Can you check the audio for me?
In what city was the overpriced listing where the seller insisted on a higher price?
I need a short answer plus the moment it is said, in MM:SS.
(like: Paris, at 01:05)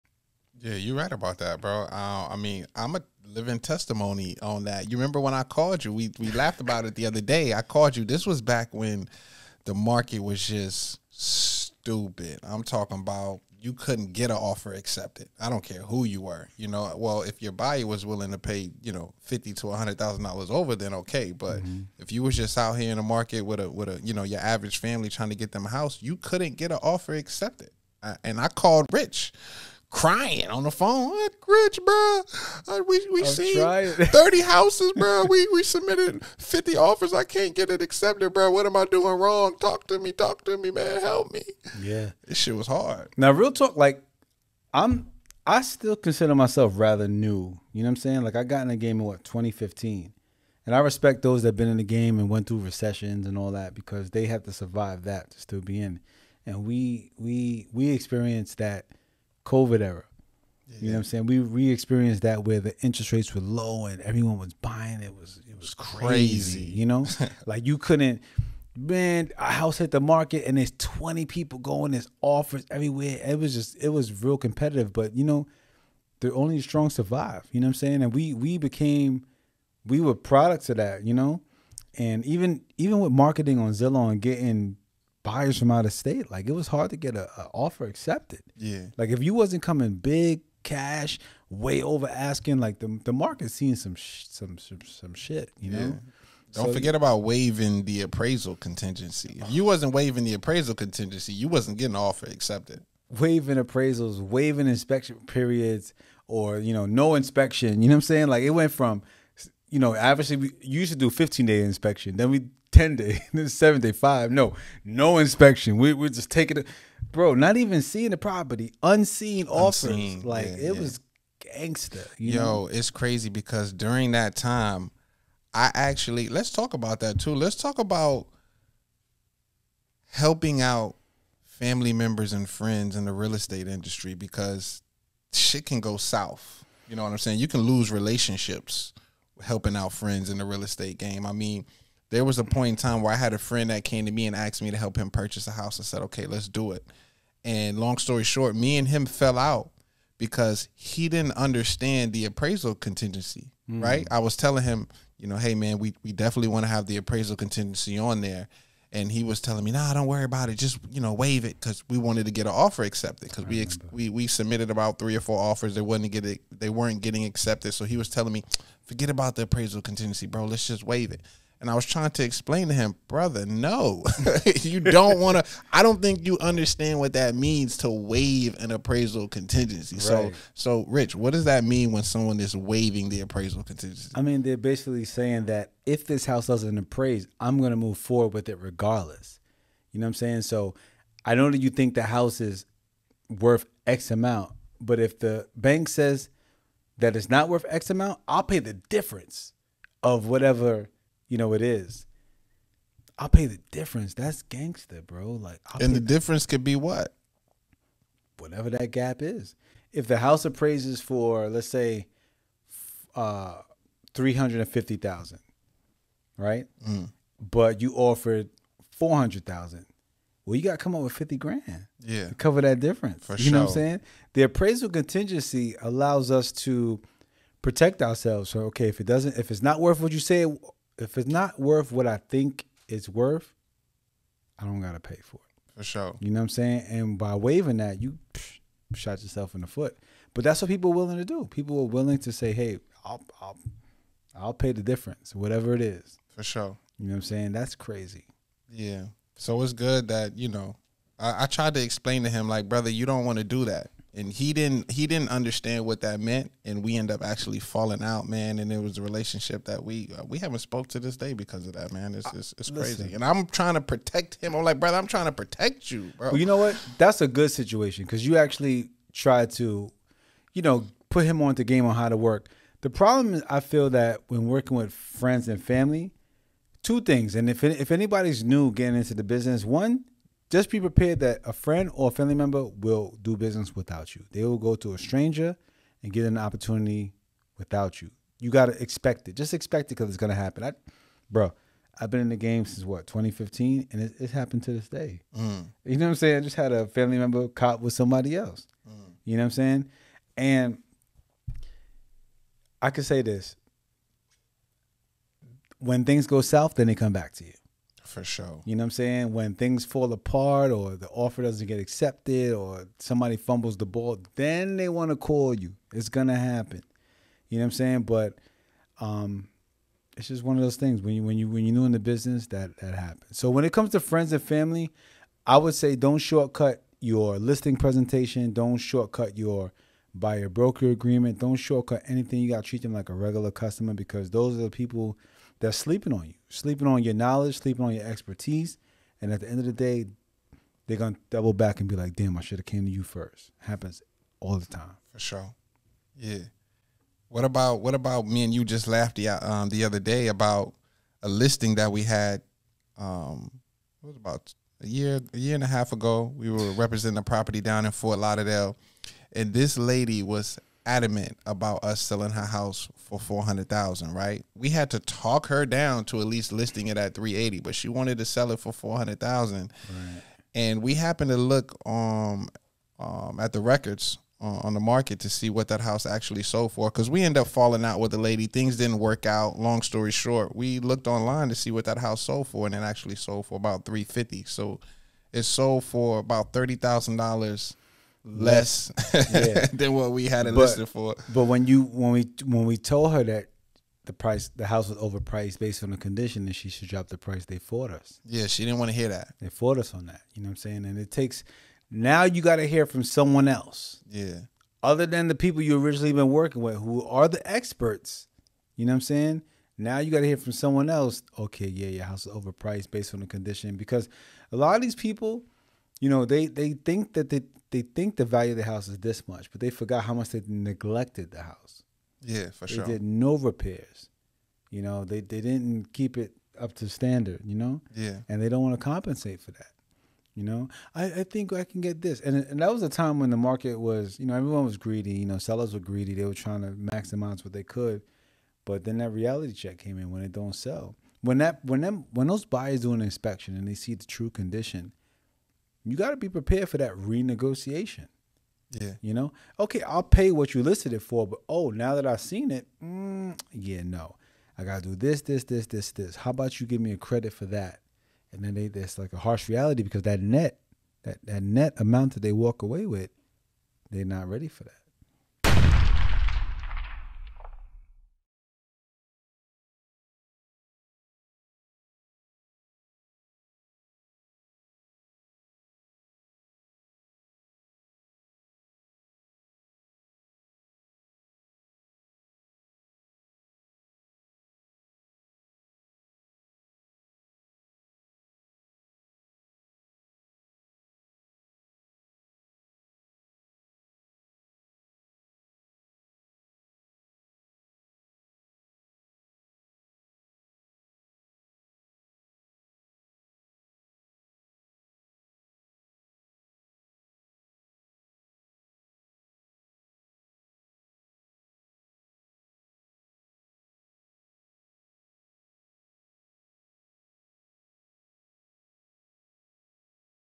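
Fort Lauderdale, at 05:57.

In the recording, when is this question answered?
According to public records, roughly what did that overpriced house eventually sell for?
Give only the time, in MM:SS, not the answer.
06:23.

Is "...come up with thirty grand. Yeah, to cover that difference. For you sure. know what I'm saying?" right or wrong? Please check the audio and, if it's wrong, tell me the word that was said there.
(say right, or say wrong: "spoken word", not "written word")
wrong: "fifty", not "thirty".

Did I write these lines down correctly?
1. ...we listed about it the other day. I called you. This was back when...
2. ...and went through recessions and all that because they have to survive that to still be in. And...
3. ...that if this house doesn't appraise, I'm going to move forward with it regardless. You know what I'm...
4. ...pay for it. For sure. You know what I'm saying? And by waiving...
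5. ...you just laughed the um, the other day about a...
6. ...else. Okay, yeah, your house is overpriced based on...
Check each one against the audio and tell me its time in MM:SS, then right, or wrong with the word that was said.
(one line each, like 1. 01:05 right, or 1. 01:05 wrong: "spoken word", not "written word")
1. 00:06 wrong: "laughed", not "listed"
2. 00:52 right
3. 03:05 right
4. 03:54 right
5. 05:48 right
6. 06:50 right.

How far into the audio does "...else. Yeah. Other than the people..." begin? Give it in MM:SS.
06:43.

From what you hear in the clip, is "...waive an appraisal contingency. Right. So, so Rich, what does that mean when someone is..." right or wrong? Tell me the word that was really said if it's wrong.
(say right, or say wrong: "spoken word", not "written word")
right.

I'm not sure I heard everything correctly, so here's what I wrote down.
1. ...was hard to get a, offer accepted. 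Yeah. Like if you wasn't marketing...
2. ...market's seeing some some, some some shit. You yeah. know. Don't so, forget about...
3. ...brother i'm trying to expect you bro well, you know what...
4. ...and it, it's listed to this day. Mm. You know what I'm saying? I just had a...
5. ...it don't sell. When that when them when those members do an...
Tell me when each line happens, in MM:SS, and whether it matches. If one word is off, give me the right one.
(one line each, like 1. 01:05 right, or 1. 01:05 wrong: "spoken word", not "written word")
1. 01:26 wrong: "coming", not "marketing"
2. 01:33 right
3. 04:24 wrong: "protect", not "expect"
4. 04:53 wrong: "happened", not "listed"
5. 07:20 wrong: "buyers", not "members".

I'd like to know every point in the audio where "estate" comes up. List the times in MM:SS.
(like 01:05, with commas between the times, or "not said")
02:13, 02:20.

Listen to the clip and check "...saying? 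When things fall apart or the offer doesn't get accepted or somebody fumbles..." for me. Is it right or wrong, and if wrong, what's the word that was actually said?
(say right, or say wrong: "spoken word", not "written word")
right.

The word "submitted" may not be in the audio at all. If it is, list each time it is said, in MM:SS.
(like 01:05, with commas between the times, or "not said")
00:35, 02:44.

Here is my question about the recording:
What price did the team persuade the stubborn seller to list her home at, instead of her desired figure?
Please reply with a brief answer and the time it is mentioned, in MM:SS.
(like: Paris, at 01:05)
380, at 06:07.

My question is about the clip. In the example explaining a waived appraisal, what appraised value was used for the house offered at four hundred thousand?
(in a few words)
$350,000.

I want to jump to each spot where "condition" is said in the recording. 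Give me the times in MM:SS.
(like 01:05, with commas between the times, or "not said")
06:35, 06:53, 07:24.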